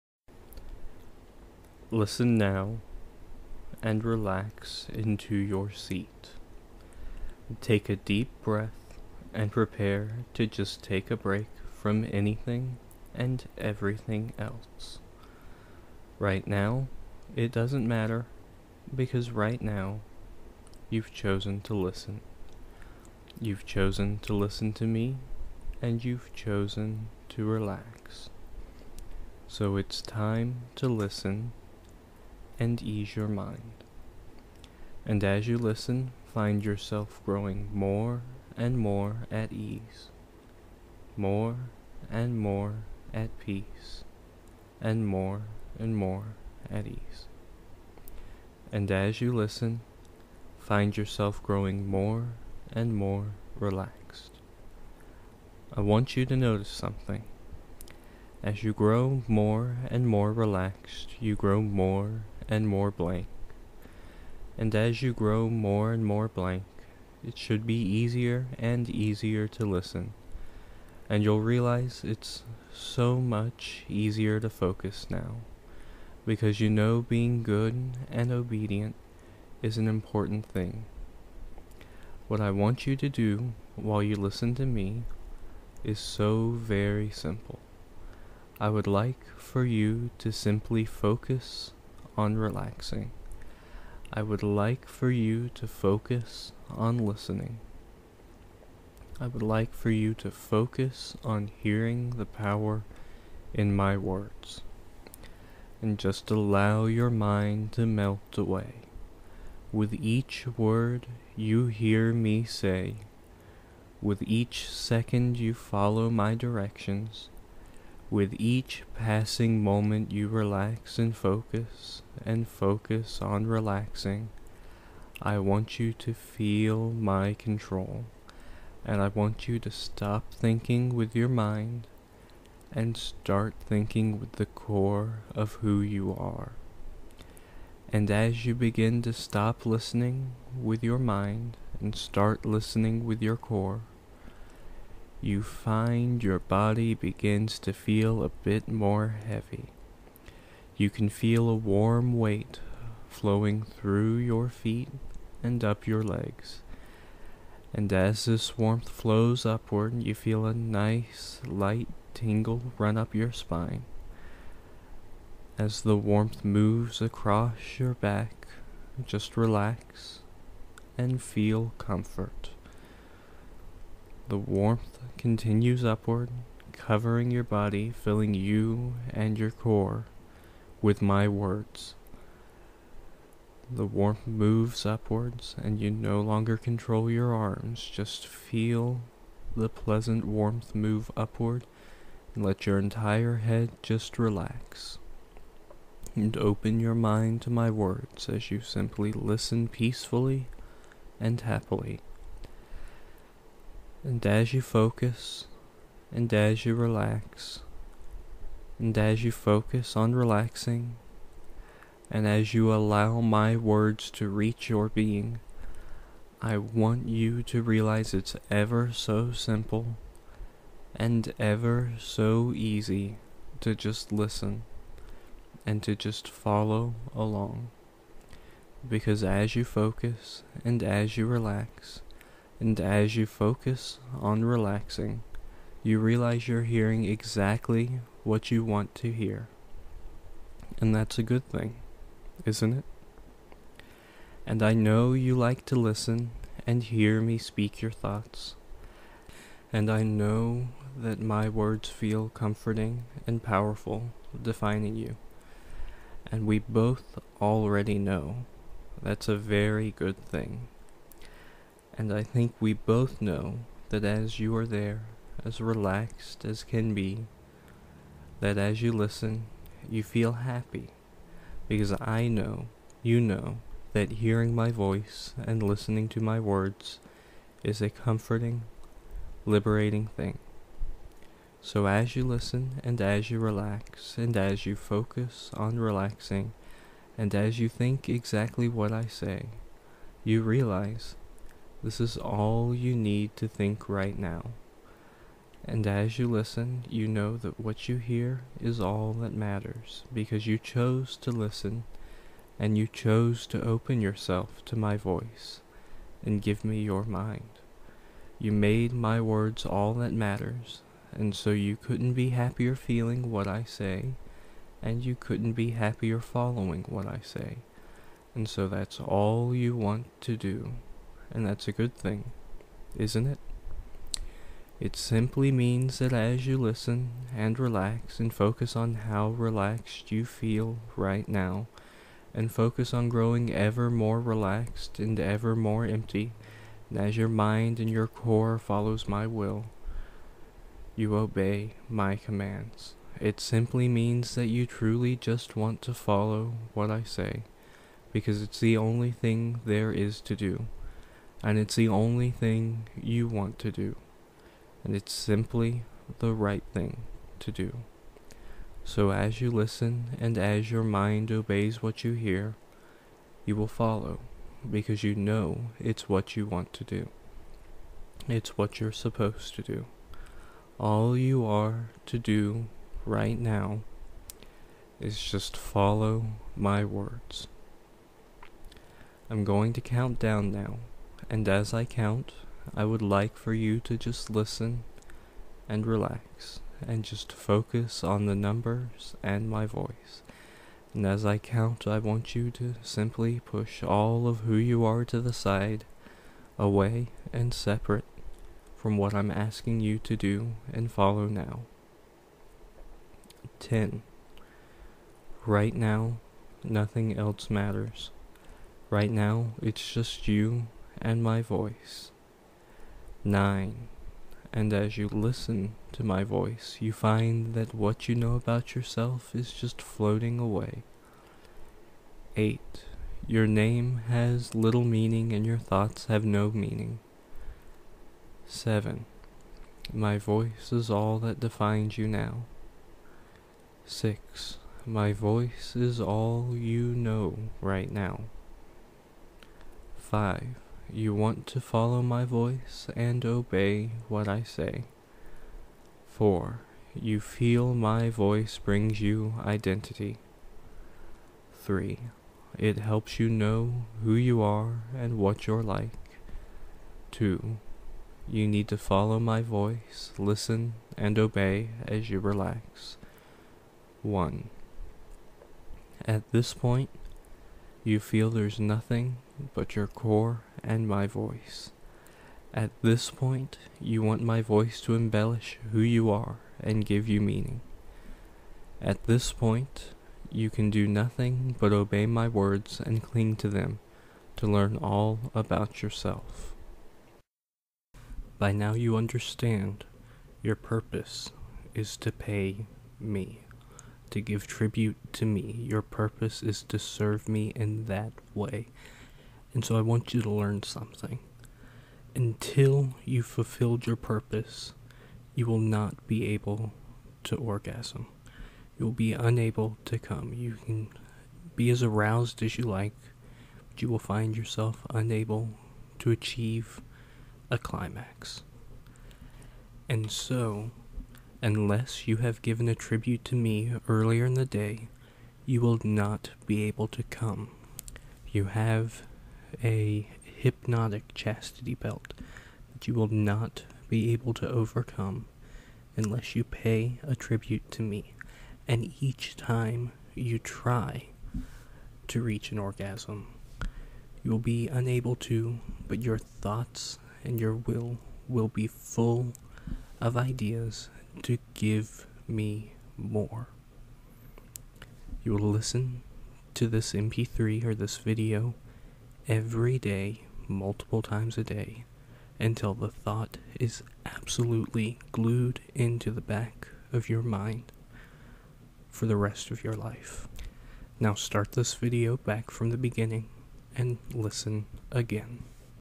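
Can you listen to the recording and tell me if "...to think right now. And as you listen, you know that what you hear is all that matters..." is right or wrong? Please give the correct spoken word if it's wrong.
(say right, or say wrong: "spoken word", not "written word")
right.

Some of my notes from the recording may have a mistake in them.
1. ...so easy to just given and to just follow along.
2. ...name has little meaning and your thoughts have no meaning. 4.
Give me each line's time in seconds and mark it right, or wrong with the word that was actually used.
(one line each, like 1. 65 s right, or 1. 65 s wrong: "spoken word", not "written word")
1. 221 s wrong: "listen", not "given"
2. 423 s wrong: "7", not "4".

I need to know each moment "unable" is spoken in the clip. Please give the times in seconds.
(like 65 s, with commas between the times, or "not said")
509 s, 514 s, 544 s.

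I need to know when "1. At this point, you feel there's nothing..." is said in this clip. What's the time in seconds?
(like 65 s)
464 s.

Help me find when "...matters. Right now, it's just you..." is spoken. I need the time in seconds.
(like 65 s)
407 s.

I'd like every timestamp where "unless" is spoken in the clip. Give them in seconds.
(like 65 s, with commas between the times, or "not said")
521 s, 535 s.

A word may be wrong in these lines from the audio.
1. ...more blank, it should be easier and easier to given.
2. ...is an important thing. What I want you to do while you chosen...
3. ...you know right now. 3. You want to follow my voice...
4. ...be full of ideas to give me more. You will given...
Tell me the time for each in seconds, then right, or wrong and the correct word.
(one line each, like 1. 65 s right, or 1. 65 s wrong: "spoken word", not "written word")
1. 66 s wrong: "listen", not "given"
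2. 79 s wrong: "listen", not "chosen"
3. 436 s wrong: "5", not "3"
4. 548 s wrong: "listen", not "given".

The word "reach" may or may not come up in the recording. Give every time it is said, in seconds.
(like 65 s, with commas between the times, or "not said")
214 s, 542 s.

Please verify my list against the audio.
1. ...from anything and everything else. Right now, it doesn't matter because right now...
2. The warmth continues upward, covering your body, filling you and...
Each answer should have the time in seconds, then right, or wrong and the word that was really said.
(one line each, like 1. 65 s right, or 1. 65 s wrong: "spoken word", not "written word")
1. 11 s right
2. 174 s right.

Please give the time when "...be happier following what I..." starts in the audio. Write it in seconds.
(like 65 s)
315 s.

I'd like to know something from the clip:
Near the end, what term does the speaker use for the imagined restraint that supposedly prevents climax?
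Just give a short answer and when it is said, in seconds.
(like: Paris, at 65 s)
hypnotic chastity belt, at 530 s.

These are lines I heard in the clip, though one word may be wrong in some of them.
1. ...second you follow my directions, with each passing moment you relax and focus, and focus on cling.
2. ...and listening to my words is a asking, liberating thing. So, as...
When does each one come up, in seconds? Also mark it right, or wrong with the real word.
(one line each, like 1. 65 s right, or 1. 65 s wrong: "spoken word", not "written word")
1. 114 s wrong: "relaxing", not "cling"
2. 275 s wrong: "comforting", not "asking".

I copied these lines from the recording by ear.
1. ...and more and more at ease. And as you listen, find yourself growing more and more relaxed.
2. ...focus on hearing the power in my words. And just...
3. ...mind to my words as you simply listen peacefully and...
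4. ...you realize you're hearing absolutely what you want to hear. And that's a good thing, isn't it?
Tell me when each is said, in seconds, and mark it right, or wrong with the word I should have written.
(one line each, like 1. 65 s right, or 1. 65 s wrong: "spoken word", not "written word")
1. 44 s right
2. 100 s right
3. 196 s right
4. 235 s wrong: "exactly", not "absolutely".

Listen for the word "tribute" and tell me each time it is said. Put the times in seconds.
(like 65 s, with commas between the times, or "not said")
494 s, 522 s, 537 s.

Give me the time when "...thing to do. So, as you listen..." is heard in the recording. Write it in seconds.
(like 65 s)
356 s.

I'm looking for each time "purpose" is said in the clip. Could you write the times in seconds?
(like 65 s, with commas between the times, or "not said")
490 s, 495 s, 503 s.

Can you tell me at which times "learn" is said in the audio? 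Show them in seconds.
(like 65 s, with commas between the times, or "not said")
484 s, 500 s.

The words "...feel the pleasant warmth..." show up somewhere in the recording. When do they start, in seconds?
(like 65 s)
188 s.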